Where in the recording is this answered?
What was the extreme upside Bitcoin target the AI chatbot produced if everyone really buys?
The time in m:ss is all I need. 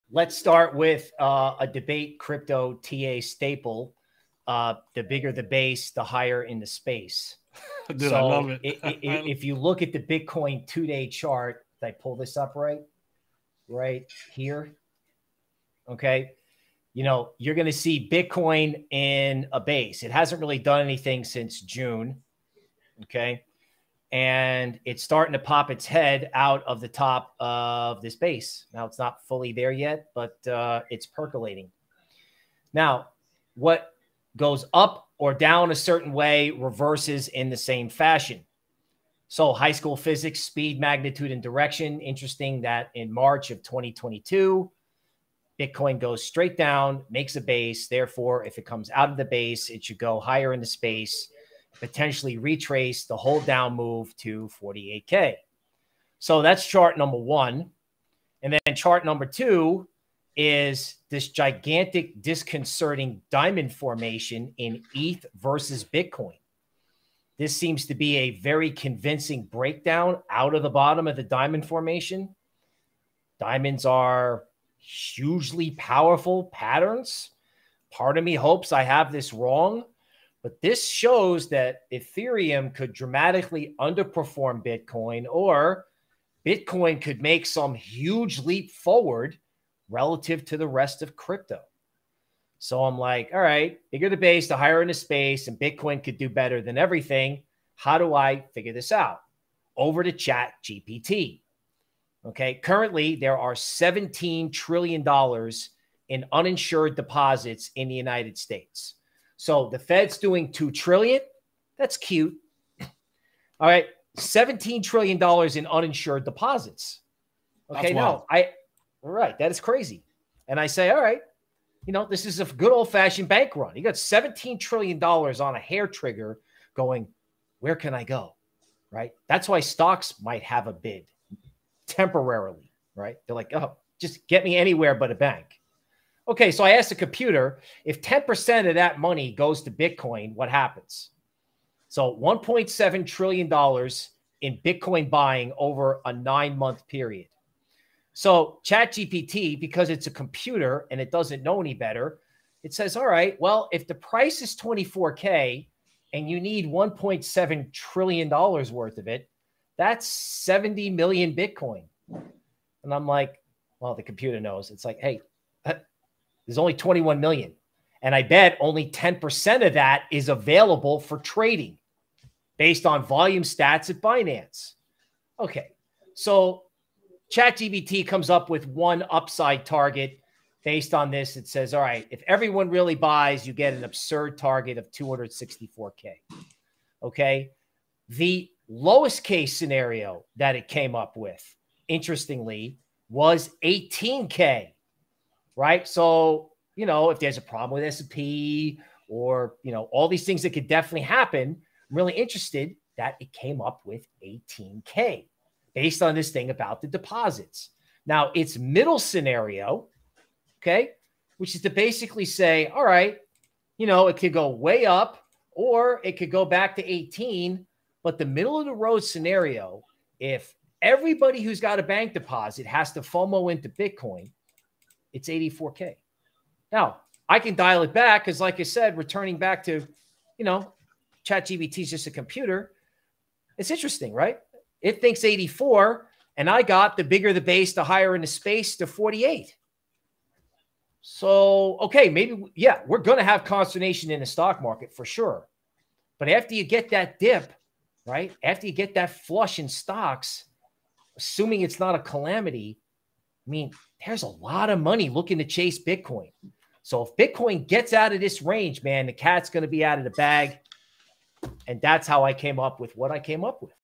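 3:04.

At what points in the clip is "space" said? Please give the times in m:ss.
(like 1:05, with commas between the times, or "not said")
0:06, 0:50, 1:34, 3:58.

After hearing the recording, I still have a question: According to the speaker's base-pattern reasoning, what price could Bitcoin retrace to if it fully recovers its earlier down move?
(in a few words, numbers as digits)
48K.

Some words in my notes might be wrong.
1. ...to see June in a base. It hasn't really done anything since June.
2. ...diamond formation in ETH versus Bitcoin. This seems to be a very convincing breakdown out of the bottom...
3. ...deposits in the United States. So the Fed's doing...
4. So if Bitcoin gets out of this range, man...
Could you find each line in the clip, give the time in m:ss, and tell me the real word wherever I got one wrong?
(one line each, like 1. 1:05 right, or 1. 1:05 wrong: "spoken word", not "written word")
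1. 0:17 wrong: "Bitcoin", not "June"
2. 1:03 right
3. 1:46 right
4. 4:16 right.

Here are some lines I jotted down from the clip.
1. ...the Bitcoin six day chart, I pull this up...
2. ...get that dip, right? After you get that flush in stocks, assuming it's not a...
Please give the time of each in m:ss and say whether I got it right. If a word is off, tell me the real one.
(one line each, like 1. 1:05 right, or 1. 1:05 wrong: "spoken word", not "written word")
1. 0:09 wrong: "two", not "six"
2. 4:06 right.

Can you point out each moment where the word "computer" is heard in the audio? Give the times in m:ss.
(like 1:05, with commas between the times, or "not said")
2:16, 2:30, 2:44, 3:52.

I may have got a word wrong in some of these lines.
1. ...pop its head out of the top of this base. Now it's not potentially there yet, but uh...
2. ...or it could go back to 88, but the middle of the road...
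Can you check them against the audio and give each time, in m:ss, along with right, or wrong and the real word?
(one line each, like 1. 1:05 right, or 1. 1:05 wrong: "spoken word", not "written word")
1. 0:25 wrong: "fully", not "potentially"
2. 3:35 wrong: "18", not "88".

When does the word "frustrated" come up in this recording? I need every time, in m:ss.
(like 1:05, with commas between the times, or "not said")
not said.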